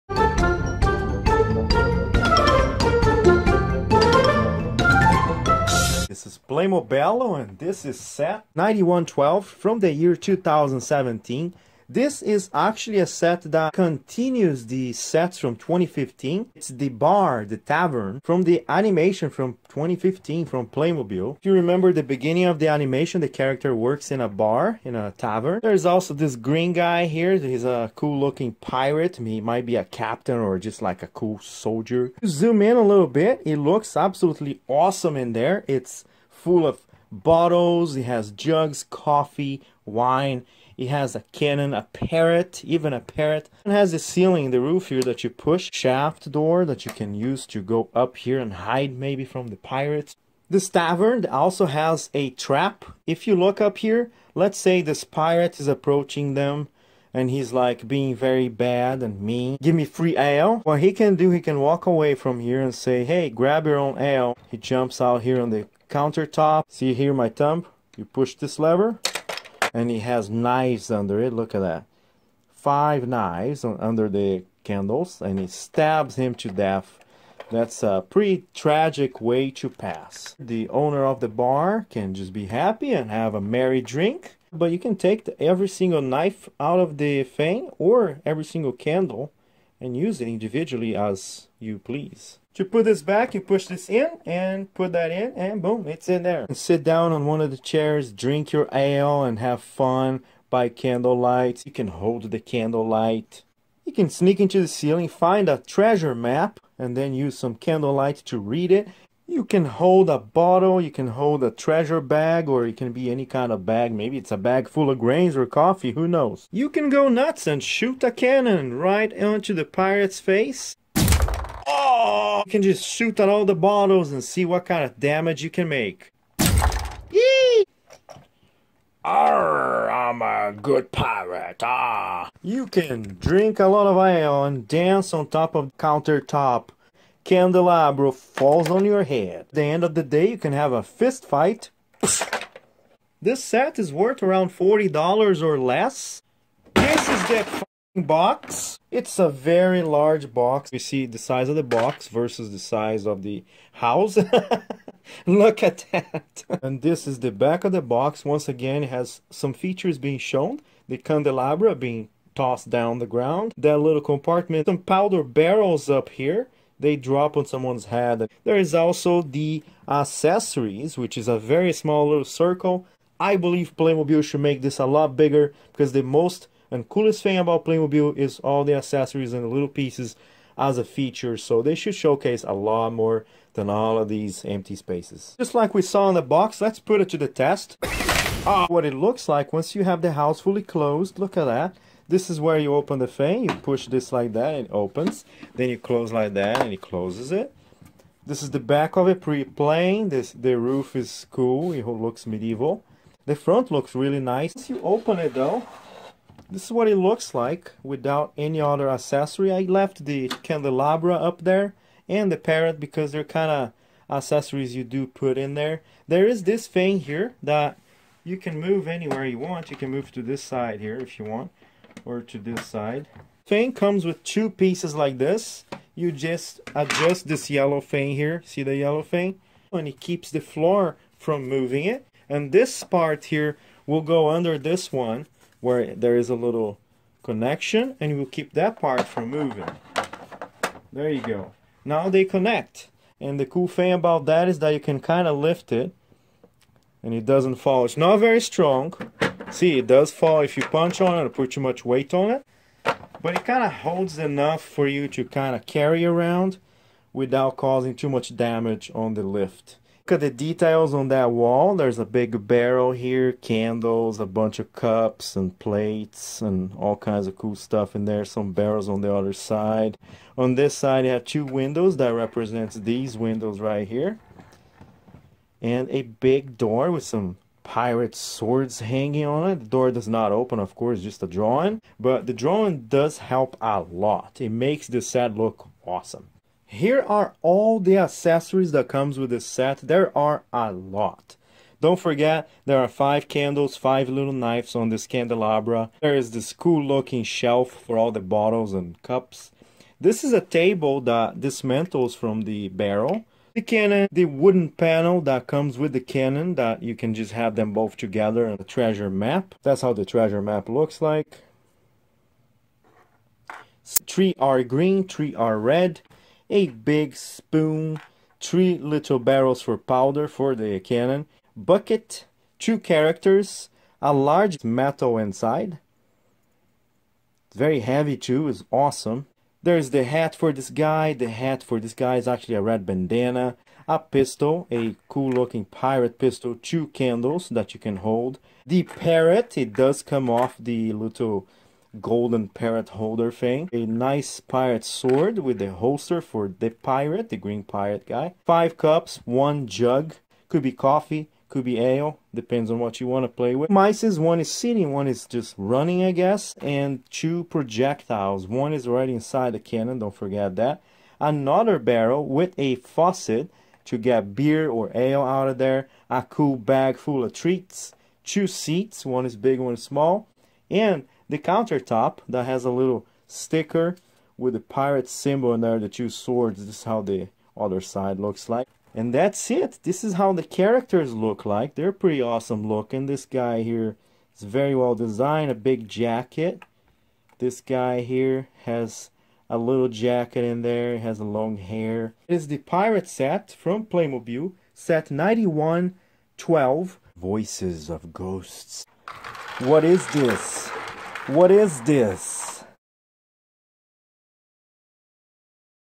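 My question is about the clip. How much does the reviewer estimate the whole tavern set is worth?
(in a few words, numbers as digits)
$40 or less.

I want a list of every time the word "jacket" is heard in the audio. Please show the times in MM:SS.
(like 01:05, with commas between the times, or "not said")
06:25, 06:29.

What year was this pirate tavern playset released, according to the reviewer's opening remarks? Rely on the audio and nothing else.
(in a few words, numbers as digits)
2017.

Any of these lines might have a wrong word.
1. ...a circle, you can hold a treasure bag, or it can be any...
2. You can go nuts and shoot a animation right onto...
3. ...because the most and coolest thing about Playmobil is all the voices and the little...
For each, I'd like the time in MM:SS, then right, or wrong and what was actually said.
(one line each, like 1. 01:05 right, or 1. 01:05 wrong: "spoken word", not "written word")
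1. 01:50 wrong: "bottle", not "circle"
2. 01:56 wrong: "cannon", not "animation"
3. 02:55 wrong: "accessories", not "voices".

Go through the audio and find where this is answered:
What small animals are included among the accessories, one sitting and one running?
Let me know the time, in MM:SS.
05:53.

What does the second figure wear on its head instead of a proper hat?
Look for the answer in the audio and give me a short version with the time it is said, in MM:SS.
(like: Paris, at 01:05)
red bandana, at 05:32.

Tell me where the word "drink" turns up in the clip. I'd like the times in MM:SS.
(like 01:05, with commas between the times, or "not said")
01:23, 01:38, 02:13.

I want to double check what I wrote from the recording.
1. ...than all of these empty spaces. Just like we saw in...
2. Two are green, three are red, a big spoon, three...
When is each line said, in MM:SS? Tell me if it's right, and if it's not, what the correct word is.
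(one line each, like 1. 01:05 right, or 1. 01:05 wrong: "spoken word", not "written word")
1. 03:03 right
2. 05:13 wrong: "Three", not "Two".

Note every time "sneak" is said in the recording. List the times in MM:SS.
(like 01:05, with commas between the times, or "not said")
01:44.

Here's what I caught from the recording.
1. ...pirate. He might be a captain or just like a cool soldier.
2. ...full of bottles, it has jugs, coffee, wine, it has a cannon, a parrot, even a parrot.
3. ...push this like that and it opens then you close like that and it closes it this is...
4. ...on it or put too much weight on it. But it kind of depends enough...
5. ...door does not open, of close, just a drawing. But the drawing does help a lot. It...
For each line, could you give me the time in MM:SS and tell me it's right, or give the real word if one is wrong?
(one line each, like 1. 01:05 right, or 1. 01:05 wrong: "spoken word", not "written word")
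1. 00:28 right
2. 00:36 right
3. 03:13 right
4. 04:11 wrong: "holds", not "depends"
5. 04:39 wrong: "course", not "close".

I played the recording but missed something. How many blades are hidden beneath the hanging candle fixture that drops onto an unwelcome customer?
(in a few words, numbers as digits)
5.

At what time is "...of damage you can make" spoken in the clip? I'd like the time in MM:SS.
02:04.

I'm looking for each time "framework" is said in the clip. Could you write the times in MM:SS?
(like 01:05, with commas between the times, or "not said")
not said.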